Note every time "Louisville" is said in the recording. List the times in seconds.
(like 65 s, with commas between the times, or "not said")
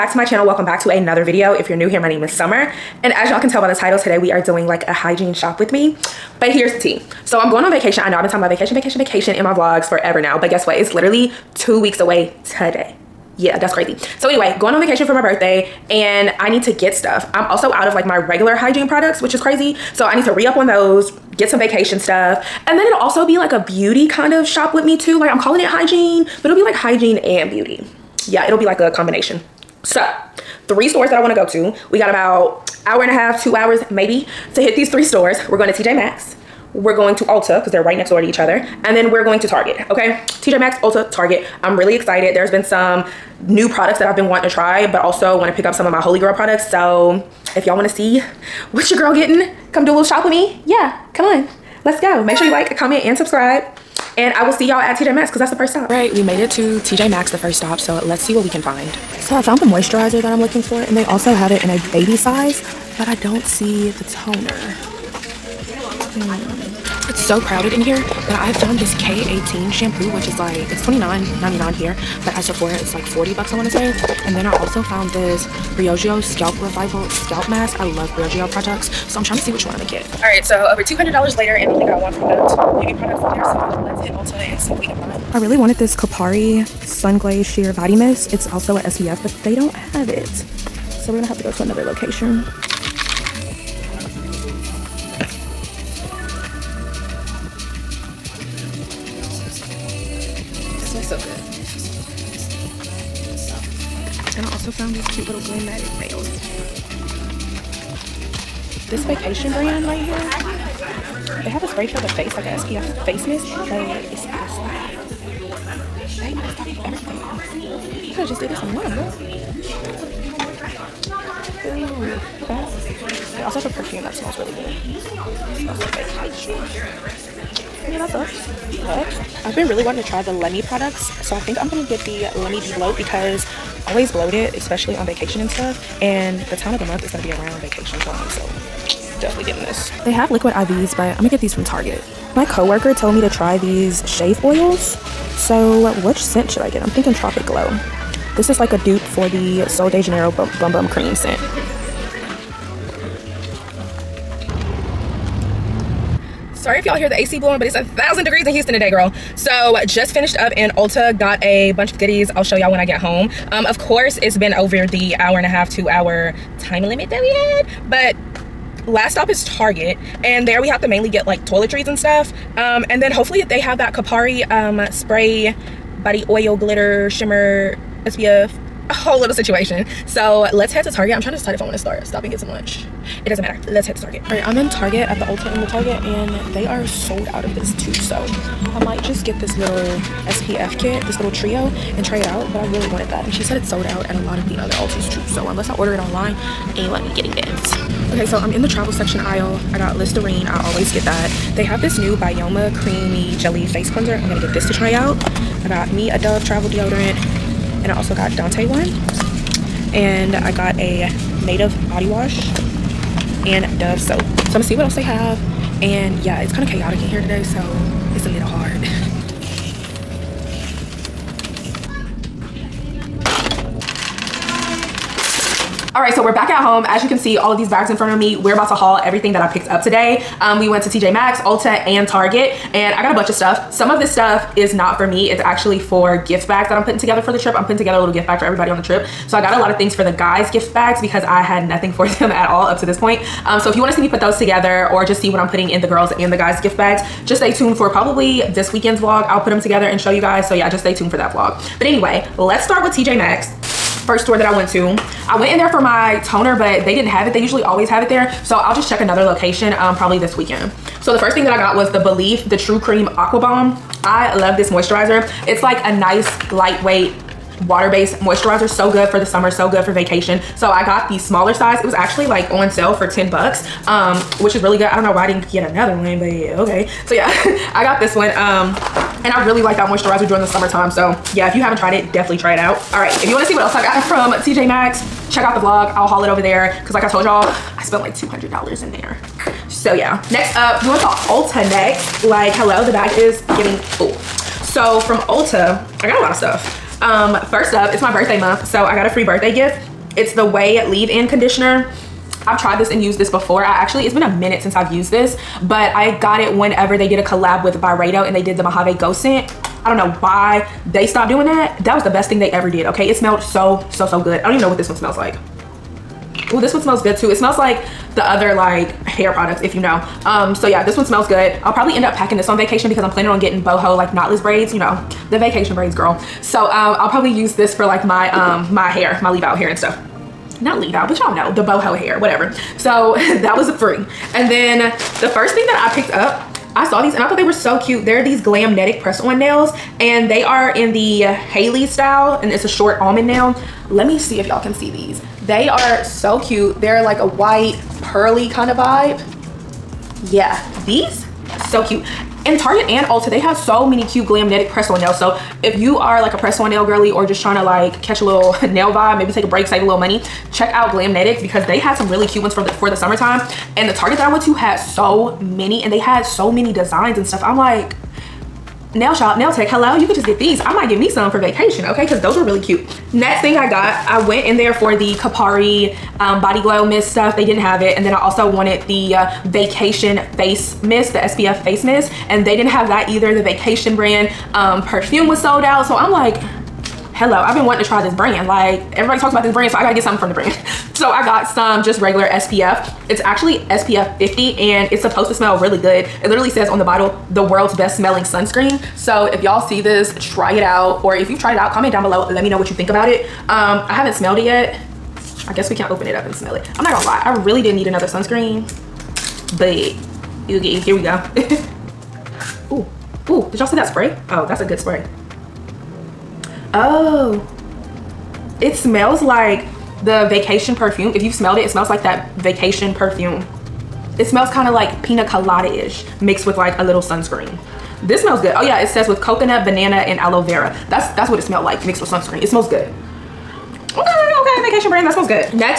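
not said.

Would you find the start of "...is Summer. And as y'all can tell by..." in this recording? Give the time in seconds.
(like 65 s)
2 s.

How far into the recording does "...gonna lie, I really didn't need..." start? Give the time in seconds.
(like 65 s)
406 s.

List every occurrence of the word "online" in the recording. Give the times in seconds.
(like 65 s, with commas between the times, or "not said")
118 s, 195 s.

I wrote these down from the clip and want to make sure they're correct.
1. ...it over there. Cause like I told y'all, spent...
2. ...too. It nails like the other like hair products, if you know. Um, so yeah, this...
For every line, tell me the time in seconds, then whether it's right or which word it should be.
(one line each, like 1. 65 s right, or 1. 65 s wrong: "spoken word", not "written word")
1. 286 s right
2. 317 s wrong: "smells", not "nails".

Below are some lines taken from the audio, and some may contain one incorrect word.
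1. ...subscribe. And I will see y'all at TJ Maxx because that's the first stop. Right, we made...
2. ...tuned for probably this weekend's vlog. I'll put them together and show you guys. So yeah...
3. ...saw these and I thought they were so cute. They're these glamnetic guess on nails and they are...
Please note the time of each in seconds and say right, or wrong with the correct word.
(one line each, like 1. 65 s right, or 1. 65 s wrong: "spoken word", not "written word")
1. 53 s right
2. 247 s right
3. 336 s wrong: "press", not "guess".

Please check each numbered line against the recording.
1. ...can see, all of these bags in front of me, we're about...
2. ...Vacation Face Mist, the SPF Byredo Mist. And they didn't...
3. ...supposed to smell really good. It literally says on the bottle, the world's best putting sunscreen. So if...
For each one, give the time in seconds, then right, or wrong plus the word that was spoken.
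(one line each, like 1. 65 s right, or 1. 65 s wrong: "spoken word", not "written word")
1. 227 s right
2. 379 s wrong: "Face", not "Byredo"
3. 395 s wrong: "smelling", not "putting".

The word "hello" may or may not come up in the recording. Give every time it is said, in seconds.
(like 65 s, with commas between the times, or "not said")
292 s, 369 s, 387 s.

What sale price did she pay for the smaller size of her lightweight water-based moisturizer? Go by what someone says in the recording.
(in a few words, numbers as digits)
$10.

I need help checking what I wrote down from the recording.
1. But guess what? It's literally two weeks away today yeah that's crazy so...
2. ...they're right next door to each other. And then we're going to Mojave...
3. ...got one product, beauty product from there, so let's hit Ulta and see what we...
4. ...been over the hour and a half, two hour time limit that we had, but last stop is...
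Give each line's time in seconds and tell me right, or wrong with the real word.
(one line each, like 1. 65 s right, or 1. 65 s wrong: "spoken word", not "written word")
1. 10 s right
2. 37 s wrong: "Target", not "Mojave"
3. 81 s right
4. 164 s right.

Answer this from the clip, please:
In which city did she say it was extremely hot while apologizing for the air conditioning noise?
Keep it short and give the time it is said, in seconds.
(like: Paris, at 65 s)
Houston, at 158 s.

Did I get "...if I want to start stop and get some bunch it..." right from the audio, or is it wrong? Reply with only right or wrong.
wrong.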